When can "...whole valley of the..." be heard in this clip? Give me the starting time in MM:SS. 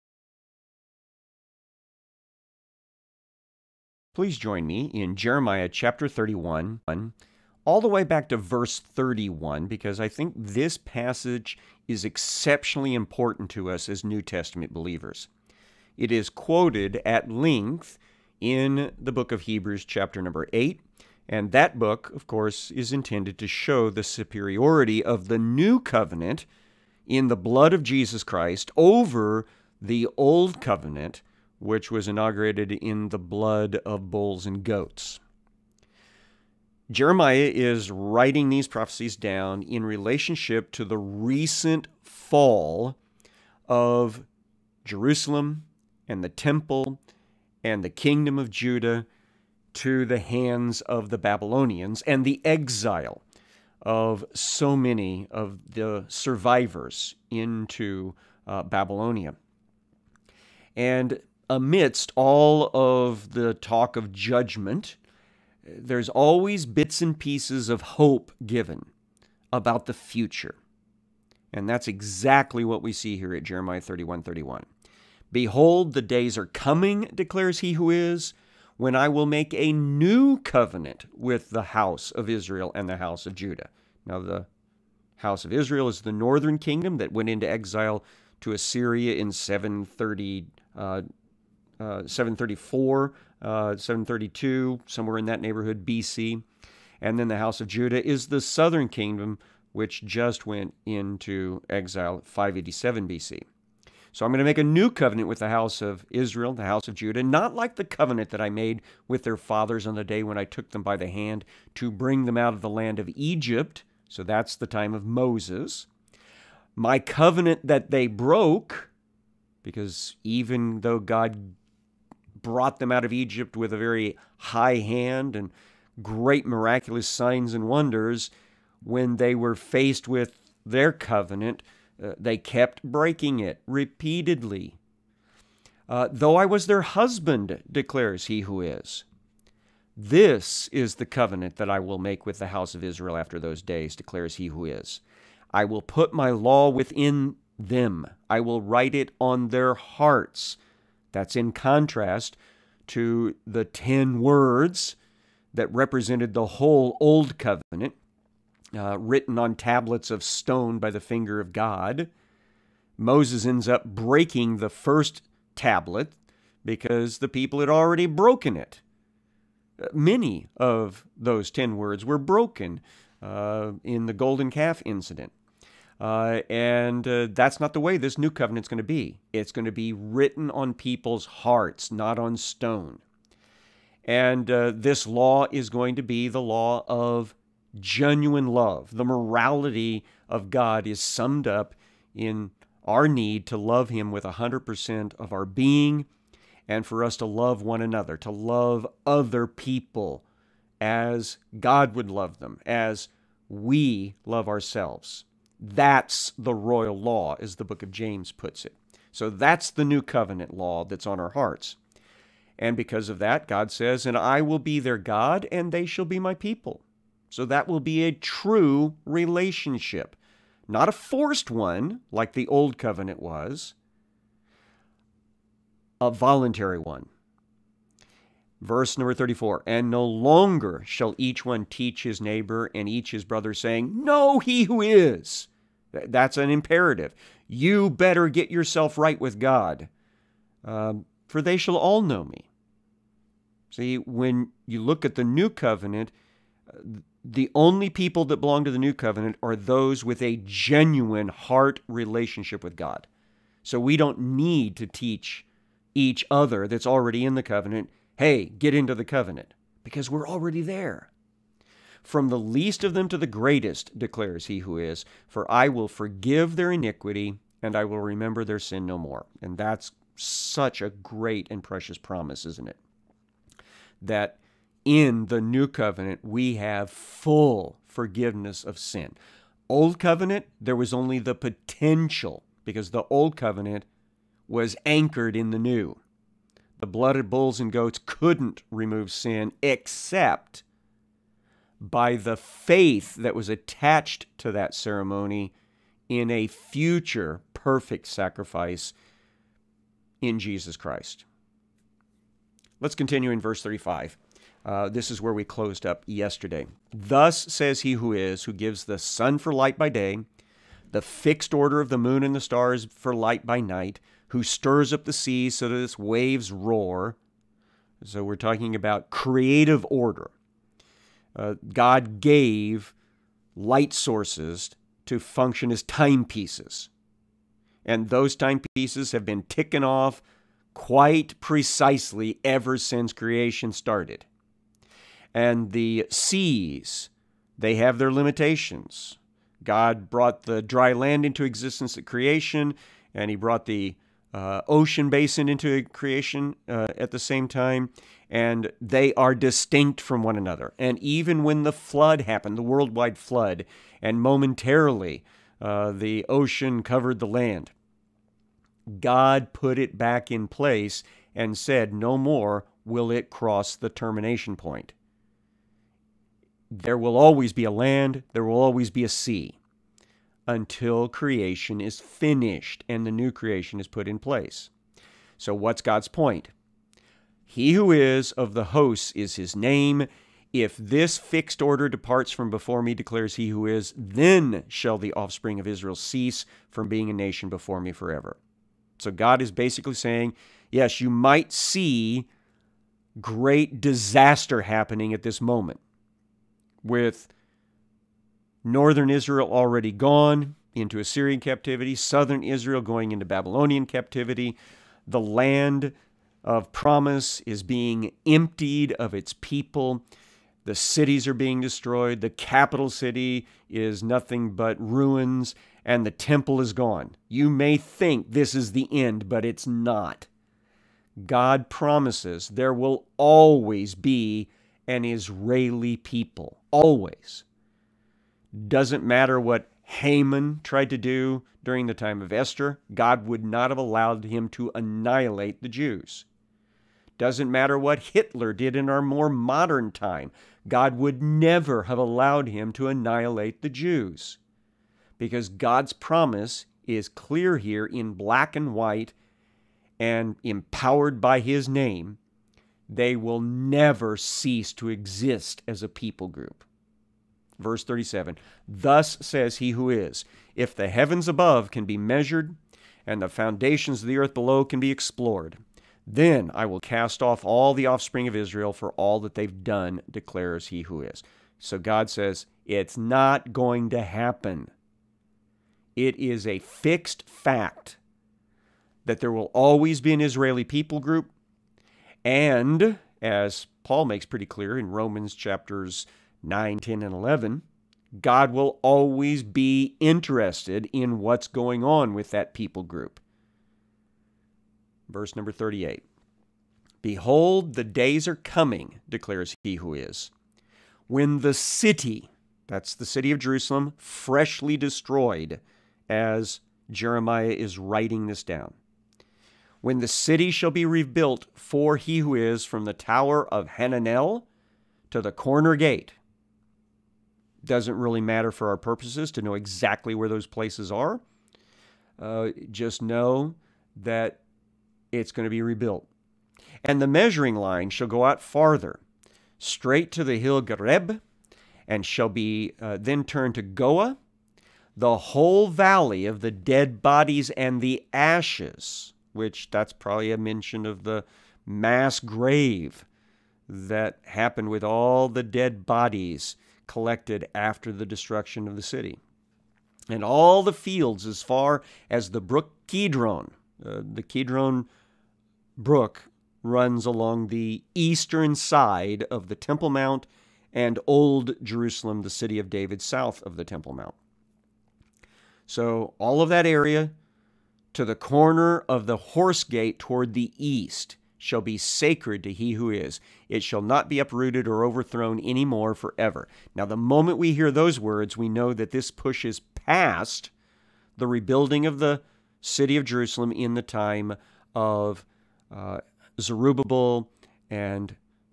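08:55.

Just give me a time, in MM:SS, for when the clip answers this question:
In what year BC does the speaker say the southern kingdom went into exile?
01:42.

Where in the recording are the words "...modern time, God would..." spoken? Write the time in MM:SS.
07:19.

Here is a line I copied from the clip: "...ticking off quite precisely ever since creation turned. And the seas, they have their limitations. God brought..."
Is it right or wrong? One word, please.
wrong.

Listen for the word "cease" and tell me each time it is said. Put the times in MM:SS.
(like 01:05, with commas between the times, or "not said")
06:25, 07:34.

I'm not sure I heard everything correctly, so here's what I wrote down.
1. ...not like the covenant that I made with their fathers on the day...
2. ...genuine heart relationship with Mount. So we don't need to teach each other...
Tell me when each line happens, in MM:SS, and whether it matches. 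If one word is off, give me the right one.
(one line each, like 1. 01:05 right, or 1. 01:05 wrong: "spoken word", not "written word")
1. 01:47 right
2. 04:10 wrong: "God", not "Mount".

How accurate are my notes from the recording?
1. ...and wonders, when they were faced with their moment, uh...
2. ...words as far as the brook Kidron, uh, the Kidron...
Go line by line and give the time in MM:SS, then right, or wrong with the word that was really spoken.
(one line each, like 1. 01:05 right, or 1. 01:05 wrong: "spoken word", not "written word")
1. 02:07 wrong: "covenant", not "moment"
2. 09:10 wrong: "fields", not "words".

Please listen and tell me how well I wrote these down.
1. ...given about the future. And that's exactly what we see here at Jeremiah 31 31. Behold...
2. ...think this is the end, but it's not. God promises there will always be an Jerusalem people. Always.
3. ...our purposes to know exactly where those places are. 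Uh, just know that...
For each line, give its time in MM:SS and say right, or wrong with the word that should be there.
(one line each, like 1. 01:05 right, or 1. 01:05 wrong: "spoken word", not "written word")
1. 01:08 right
2. 06:57 wrong: "Israeli", not "Jerusalem"
3. 08:38 right.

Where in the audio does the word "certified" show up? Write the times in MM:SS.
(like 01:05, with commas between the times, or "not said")
not said.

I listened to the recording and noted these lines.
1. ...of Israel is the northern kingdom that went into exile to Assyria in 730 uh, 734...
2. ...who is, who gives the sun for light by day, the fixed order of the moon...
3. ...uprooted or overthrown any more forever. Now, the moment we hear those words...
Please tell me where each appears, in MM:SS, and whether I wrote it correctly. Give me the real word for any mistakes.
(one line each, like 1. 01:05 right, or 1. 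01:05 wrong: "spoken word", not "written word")
1. 01:25 right
2. 05:07 right
3. 09:34 right.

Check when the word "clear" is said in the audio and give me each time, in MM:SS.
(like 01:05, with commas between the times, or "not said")
07:27, 08:04.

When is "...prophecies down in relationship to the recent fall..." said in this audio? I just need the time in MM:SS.
00:38.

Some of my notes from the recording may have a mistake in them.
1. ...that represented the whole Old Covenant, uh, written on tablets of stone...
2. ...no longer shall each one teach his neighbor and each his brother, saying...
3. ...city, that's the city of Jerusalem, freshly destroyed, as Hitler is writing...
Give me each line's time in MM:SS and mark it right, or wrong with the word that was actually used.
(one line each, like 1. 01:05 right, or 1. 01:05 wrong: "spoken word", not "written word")
1. 02:35 right
2. 03:49 right
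3. 08:21 wrong: "Jeremiah", not "Hitler".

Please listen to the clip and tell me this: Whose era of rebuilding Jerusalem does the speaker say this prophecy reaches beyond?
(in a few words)
Zerubbabel.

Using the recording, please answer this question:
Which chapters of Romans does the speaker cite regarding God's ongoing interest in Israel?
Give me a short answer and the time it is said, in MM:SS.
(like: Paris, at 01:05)
9, 10, and 11, at 08:06.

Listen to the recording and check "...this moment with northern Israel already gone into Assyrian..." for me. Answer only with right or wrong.
right.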